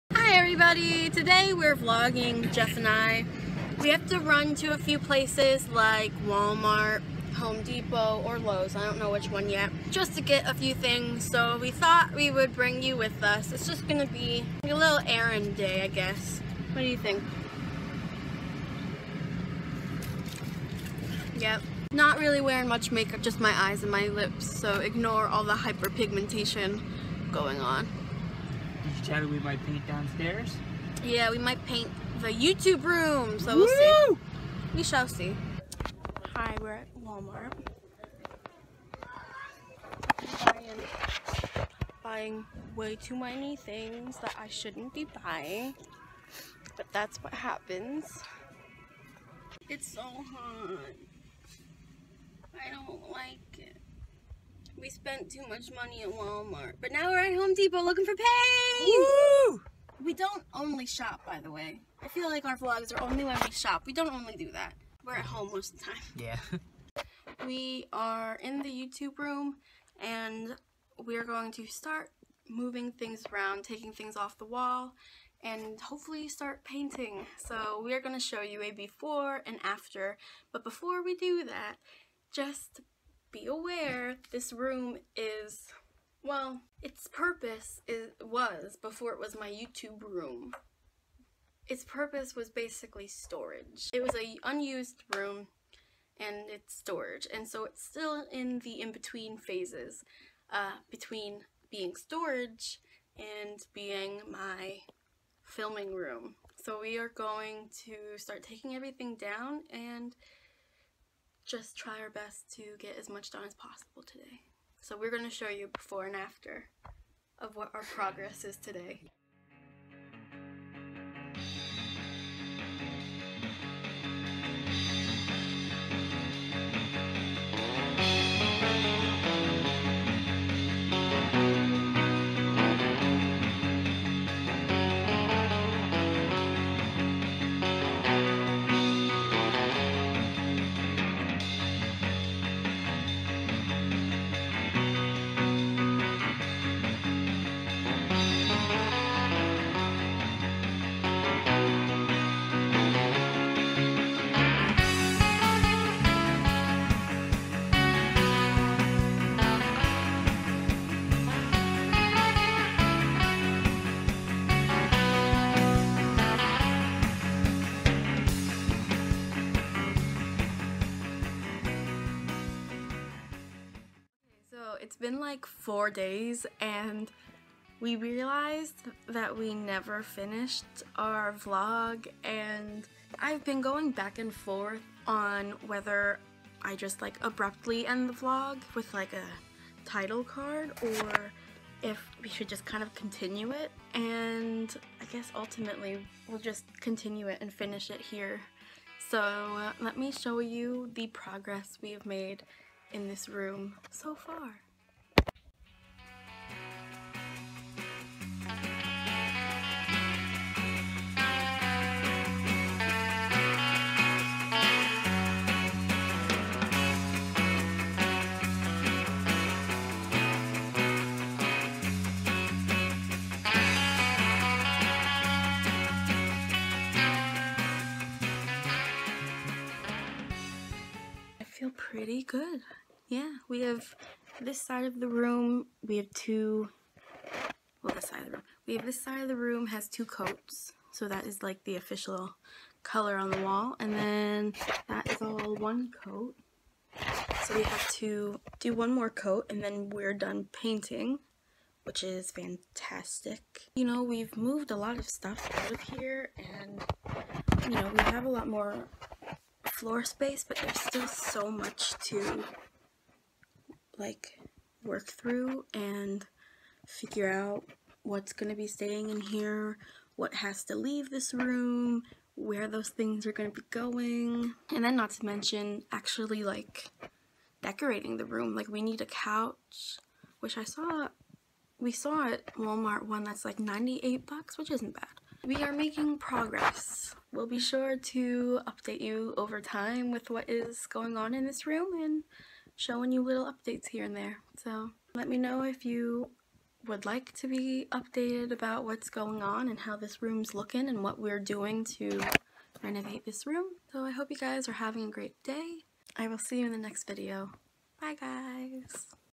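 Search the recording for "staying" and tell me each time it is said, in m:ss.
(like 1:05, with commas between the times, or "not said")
4:28.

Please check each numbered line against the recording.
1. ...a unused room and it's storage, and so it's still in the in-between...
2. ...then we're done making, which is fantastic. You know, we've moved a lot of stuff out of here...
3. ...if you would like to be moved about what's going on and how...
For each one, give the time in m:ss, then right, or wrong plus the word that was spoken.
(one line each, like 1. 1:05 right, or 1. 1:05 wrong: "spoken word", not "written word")
1. 1:34 right
2. 4:09 wrong: "painting", not "making"
3. 4:55 wrong: "updated", not "moved".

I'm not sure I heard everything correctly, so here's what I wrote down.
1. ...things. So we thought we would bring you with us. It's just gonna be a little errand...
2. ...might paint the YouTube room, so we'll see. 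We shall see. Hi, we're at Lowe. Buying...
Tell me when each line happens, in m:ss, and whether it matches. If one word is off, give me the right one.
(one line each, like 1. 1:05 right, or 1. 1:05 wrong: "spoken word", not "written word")
1. 0:10 right
2. 0:31 wrong: "Walmart", not "Lowe".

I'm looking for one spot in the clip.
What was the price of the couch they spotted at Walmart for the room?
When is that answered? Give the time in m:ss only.
4:43.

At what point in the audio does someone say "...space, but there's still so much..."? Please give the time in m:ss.
4:20.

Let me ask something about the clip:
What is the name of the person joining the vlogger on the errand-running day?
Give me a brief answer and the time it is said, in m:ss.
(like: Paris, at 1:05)
Jeff, at 0:02.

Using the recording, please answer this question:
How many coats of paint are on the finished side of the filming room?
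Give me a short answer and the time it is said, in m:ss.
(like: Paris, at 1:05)
2, at 3:59.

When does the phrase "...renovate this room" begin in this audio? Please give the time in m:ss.
5:02.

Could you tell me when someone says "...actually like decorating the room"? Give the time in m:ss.
4:35.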